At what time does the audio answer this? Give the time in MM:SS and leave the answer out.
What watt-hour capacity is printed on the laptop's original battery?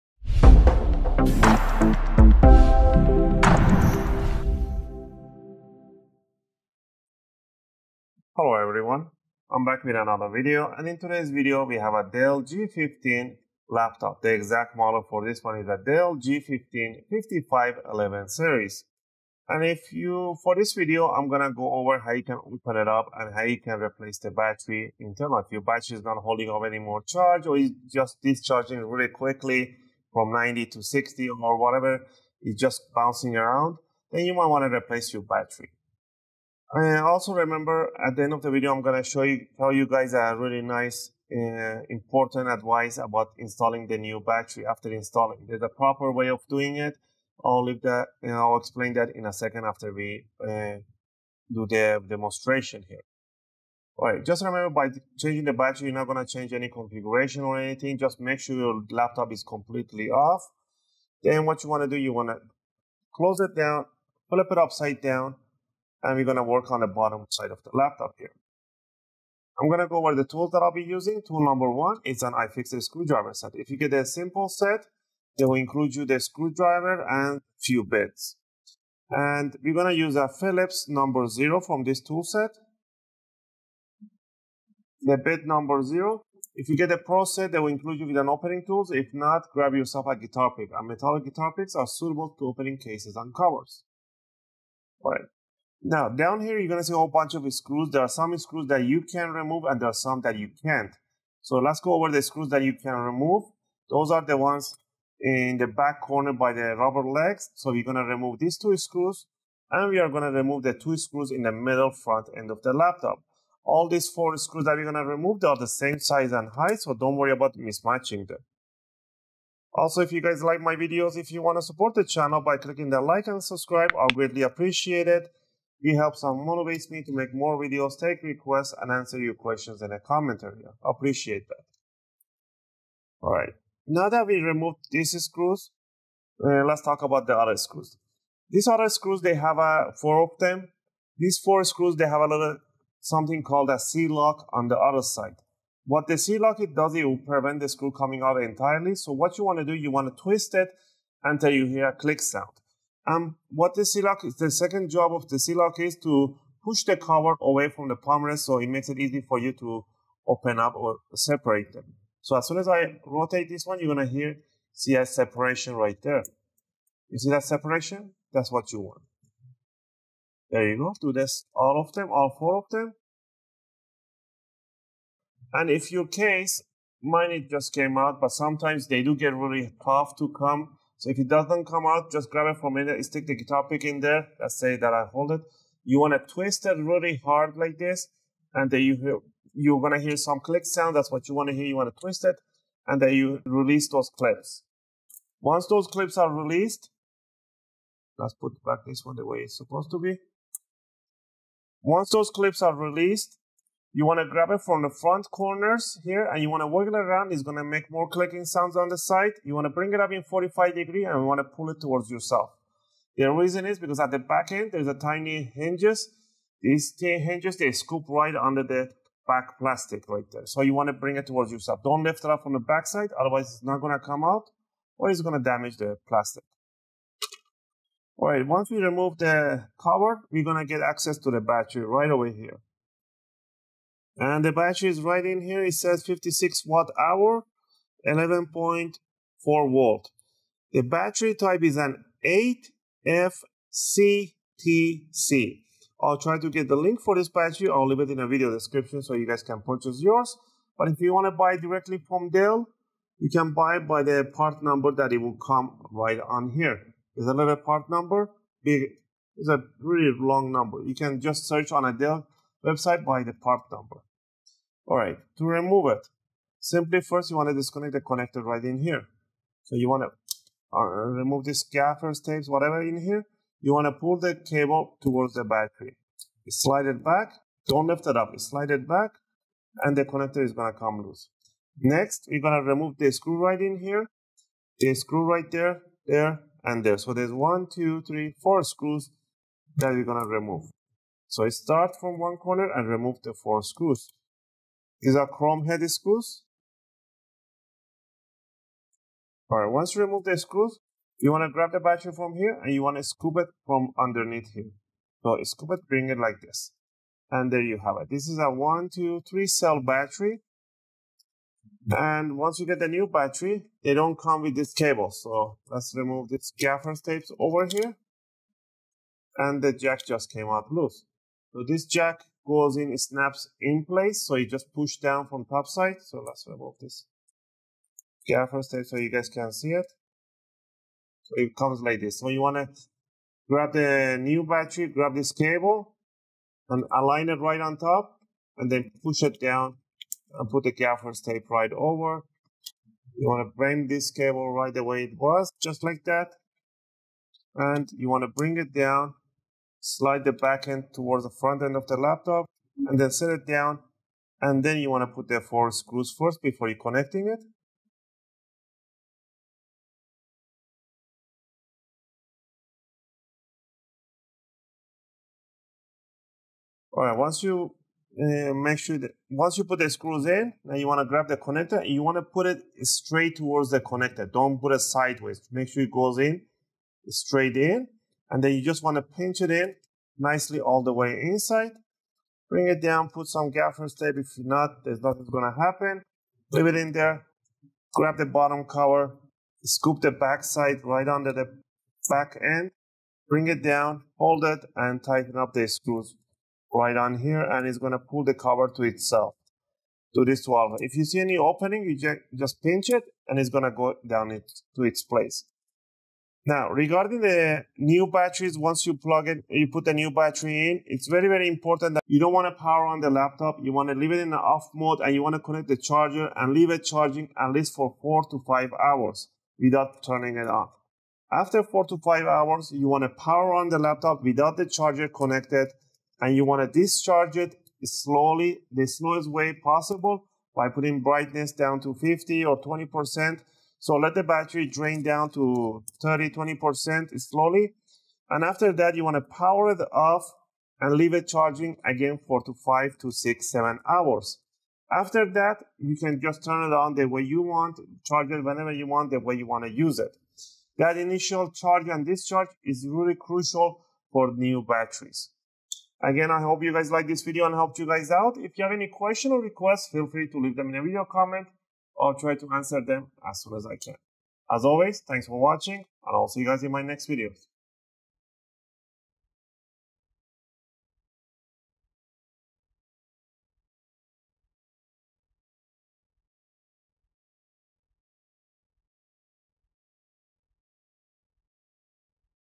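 03:56.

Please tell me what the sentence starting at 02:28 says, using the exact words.
So what you want to do, you want to twist it until you hear a click sound.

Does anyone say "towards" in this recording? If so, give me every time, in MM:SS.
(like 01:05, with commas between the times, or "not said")
03:31, 03:41, 04:35, 05:50, 06:13.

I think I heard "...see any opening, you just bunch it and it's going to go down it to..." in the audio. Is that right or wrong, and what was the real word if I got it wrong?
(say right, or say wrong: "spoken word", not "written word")
wrong: "pinch", not "bunch".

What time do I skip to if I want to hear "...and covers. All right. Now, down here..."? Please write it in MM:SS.
01:33.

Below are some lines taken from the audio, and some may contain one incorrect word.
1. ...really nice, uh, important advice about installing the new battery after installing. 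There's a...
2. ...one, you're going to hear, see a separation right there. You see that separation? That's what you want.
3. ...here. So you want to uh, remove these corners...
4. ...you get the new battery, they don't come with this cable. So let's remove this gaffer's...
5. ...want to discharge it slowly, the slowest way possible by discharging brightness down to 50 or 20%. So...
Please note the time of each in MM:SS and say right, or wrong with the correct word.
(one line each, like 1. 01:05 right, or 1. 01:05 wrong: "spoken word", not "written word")
1. 00:40 right
2. 02:43 right
3. 04:28 wrong: "gaffers", not "corners"
4. 05:12 right
5. 07:06 wrong: "putting", not "discharging".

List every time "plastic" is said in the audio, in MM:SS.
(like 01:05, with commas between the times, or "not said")
03:39, 03:46.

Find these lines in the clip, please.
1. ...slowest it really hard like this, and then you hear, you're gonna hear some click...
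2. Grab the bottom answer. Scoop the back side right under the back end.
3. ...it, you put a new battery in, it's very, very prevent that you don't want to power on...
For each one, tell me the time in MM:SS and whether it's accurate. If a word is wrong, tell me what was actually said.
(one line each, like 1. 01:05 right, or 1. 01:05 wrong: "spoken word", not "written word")
1. 03:06 wrong: "twist", not "slowest"
2. 06:27 wrong: "cover", not "answer"
3. 06:49 wrong: "important", not "prevent".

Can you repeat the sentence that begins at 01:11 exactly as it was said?
Tool number one is an iFixit screwdriver set.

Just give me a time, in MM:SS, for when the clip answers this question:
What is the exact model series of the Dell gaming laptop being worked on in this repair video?
00:15.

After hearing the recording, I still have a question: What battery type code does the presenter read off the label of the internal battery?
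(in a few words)
8FCTC.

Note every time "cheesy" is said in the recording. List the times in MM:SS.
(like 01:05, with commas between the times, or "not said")
not said.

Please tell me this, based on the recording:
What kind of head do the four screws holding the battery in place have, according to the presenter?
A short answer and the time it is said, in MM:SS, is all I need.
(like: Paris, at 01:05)
Chrome head, at 04:55.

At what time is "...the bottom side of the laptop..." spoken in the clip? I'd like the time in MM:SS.
01:06.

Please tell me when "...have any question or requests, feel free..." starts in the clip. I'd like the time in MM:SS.
07:38.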